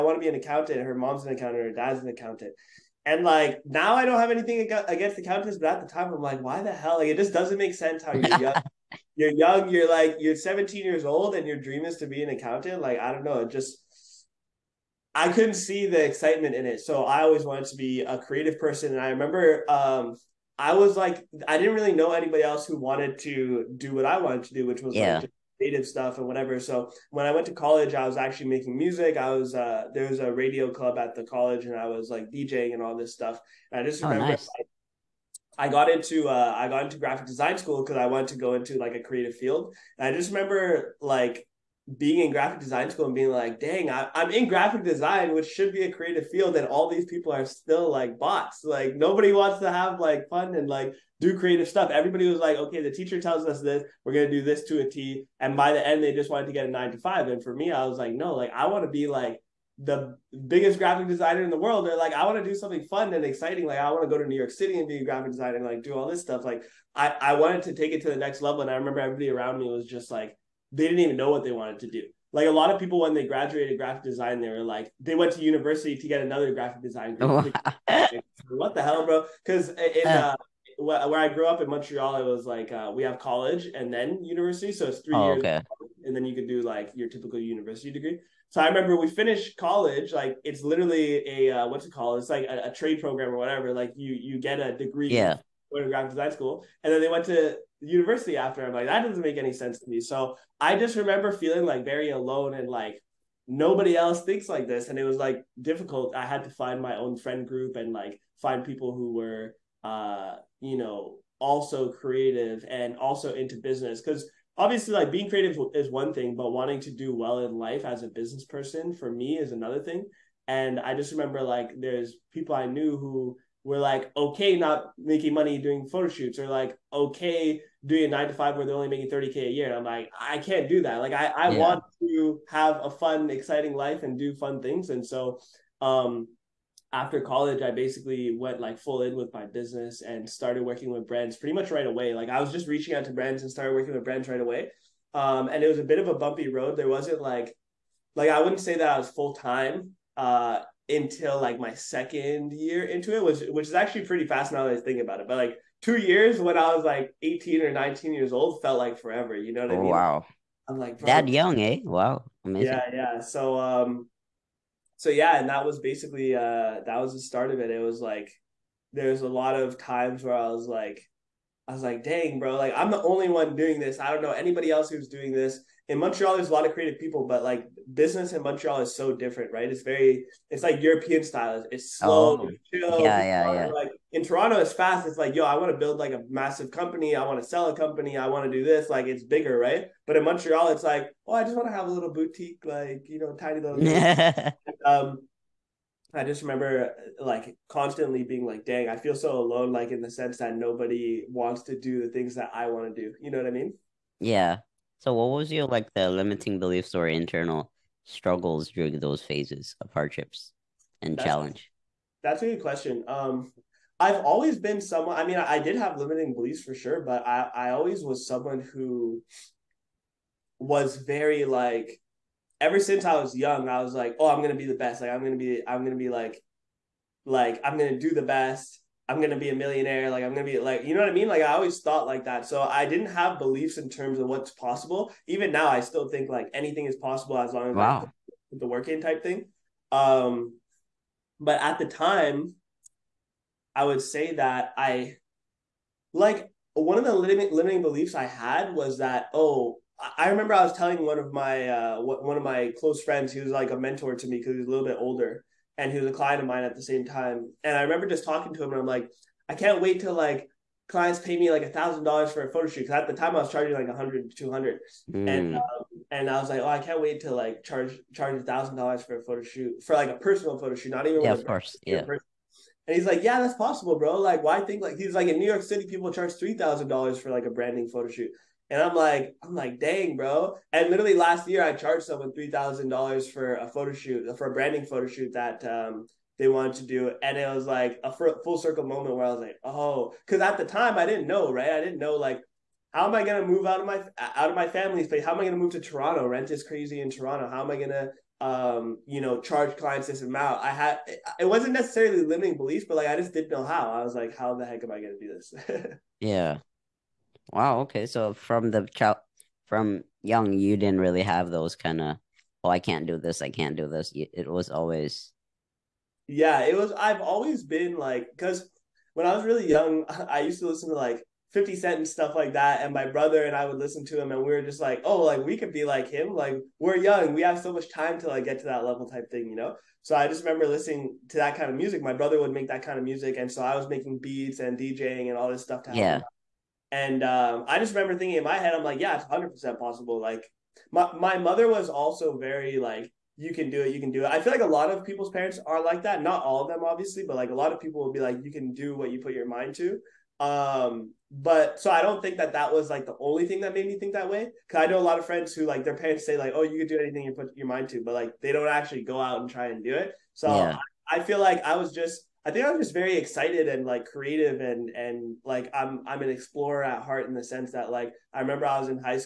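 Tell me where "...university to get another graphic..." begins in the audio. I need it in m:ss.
1:15.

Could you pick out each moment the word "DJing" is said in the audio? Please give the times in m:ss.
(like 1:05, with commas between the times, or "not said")
0:32, 5:34.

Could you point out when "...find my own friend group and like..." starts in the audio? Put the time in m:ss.
1:46.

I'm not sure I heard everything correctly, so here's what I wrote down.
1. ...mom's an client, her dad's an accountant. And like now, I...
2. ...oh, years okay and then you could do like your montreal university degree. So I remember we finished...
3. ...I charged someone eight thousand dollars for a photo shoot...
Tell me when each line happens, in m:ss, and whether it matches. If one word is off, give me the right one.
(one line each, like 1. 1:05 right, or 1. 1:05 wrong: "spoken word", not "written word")
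1. 0:00 wrong: "accountant", not "client"
2. 1:25 wrong: "typical", not "montreal"
3. 4:41 wrong: "three", not "eight".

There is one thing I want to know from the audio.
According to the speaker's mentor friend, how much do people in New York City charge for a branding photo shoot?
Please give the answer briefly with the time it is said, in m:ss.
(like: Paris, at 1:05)
$3,000, at 4:36.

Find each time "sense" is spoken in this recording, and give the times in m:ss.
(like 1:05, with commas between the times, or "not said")
0:07, 1:39, 3:20, 6:07.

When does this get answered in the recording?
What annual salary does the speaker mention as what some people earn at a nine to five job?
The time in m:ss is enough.
2:09.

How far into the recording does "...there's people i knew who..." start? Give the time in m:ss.
2:01.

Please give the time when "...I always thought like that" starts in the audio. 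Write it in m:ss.
3:51.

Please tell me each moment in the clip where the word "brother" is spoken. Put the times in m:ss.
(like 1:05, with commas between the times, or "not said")
5:23, 5:32.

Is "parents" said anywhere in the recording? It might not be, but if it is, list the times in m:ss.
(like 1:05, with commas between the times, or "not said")
5:45, 5:55.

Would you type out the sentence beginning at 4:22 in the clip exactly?
Cause at the time I was charging like 100, 200.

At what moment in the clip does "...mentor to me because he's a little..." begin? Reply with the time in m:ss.
4:13.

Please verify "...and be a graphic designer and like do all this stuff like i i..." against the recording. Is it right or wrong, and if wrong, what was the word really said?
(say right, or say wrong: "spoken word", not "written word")
right.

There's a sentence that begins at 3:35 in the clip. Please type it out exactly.
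I mean, I, I did have limiting beliefs for sure, but I I always was someone who was very like.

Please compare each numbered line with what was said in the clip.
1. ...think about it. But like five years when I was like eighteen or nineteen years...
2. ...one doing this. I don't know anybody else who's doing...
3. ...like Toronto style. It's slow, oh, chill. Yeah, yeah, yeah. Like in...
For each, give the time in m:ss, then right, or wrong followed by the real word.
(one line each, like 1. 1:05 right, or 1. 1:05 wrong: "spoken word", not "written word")
1. 2:34 wrong: "two", not "five"
2. 2:53 right
3. 3:00 wrong: "European", not "Toronto".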